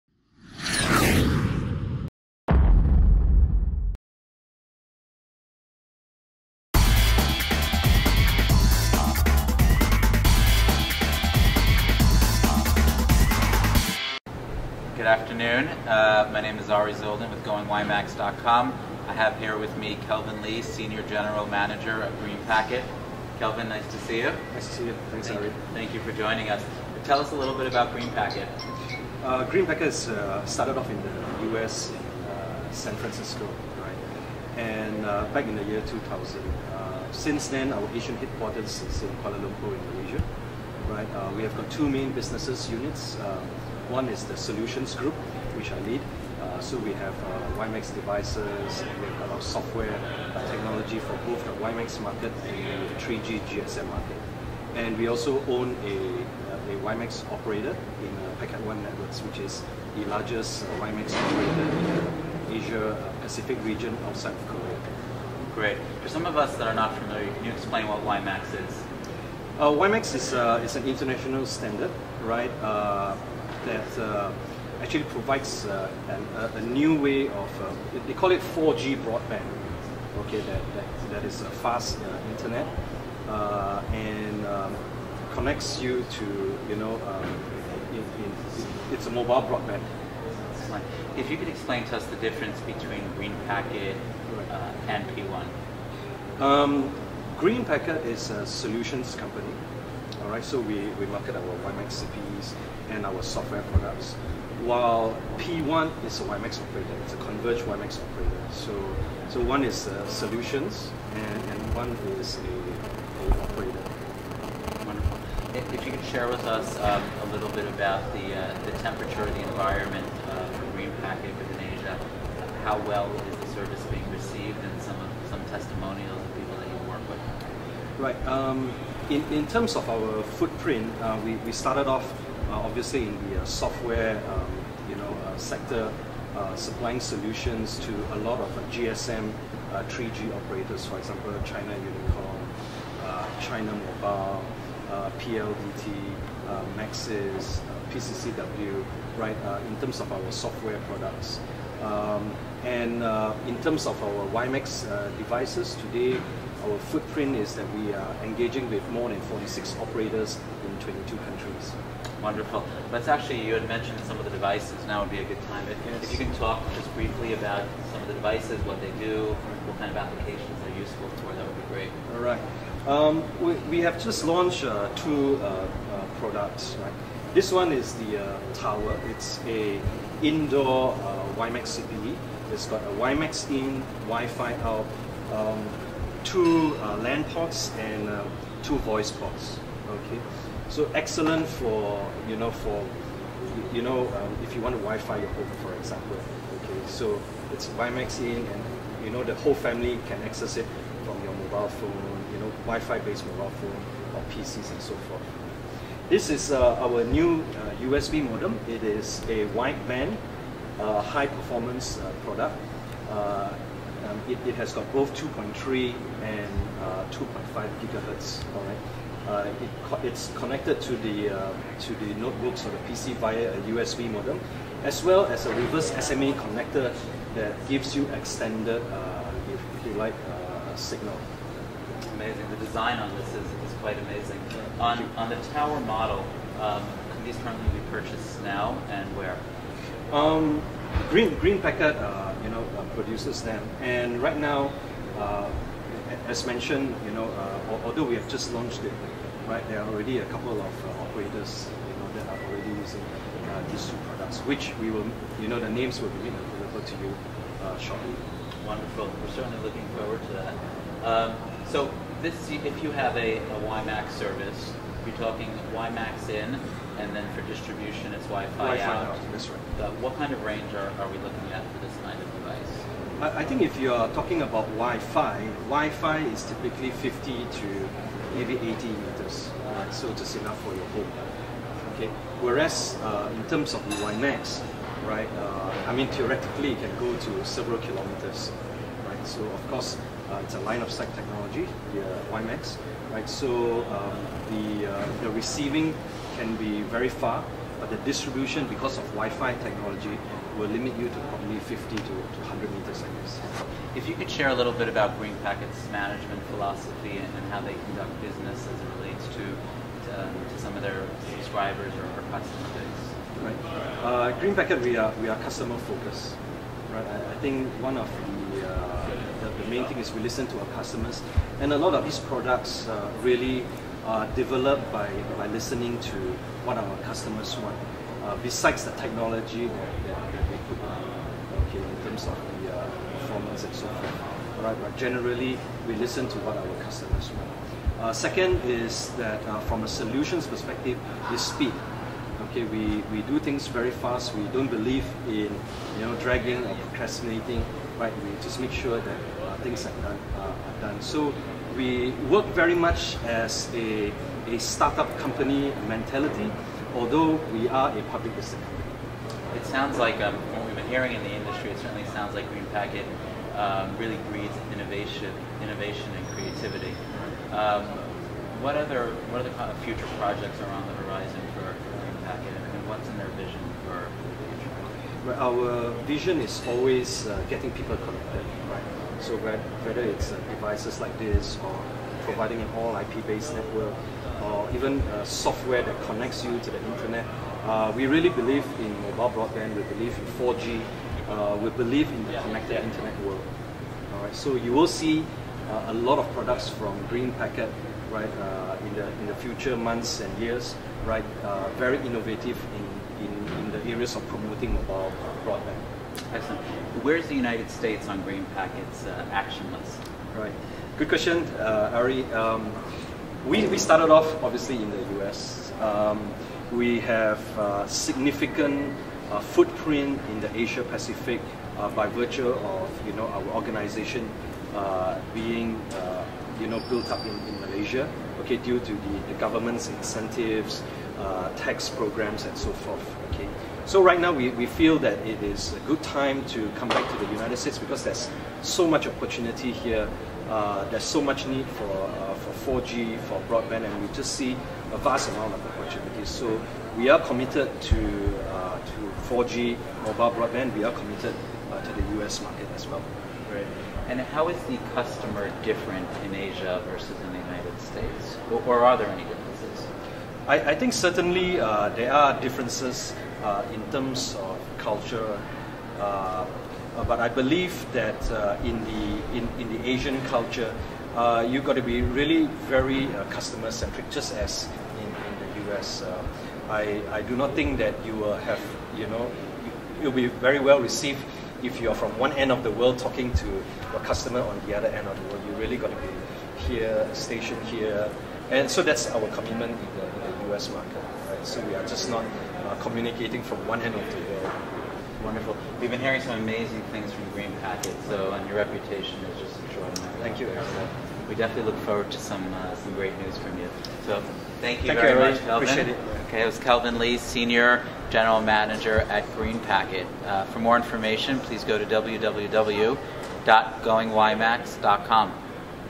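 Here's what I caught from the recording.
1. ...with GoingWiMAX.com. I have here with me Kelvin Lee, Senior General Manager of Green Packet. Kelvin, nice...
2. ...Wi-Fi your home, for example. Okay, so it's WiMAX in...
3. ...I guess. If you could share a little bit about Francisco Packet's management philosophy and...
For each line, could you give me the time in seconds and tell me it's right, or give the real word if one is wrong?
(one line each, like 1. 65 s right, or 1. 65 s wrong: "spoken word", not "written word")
1. 17 s right
2. 194 s right
3. 303 s wrong: "Green", not "Francisco".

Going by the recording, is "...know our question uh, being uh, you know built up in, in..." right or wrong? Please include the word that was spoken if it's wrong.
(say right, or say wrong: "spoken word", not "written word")
wrong: "organization", not "question".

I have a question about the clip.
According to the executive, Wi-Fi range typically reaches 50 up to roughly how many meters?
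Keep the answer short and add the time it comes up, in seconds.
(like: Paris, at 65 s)
80 meters, at 278 s.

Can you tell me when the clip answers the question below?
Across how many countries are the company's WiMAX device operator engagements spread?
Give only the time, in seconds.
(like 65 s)
160 s.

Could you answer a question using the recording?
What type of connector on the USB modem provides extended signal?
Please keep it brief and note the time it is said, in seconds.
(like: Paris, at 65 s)
reverse SMA connector, at 225 s.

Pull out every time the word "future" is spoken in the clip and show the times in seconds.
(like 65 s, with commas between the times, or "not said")
369 s, 375 s, 399 s.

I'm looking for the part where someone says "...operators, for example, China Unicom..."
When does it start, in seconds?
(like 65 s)
140 s.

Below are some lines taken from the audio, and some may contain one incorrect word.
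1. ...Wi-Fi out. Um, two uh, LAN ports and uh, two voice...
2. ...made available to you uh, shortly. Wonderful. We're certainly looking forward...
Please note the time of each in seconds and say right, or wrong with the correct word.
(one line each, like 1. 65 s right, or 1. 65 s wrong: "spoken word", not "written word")
1. 184 s right
2. 256 s right.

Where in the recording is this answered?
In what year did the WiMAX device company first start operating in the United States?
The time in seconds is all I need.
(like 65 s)
35 s.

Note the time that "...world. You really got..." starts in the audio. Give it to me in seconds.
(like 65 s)
485 s.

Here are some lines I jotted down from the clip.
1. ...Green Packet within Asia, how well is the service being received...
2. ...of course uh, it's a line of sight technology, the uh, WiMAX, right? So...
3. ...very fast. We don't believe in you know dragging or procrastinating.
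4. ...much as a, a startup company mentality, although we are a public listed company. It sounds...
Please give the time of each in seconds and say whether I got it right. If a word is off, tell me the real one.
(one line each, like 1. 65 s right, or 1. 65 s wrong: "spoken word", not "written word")
1. 120 s right
2. 289 s right
3. 343 s right
4. 352 s right.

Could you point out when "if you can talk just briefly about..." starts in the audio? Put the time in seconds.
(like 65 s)
166 s.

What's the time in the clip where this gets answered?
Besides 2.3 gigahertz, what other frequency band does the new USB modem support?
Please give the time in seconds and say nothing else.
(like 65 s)
217 s.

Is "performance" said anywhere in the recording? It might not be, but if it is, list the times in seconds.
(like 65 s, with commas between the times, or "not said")
211 s, 333 s.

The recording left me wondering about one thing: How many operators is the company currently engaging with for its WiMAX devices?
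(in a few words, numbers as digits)
more than 46.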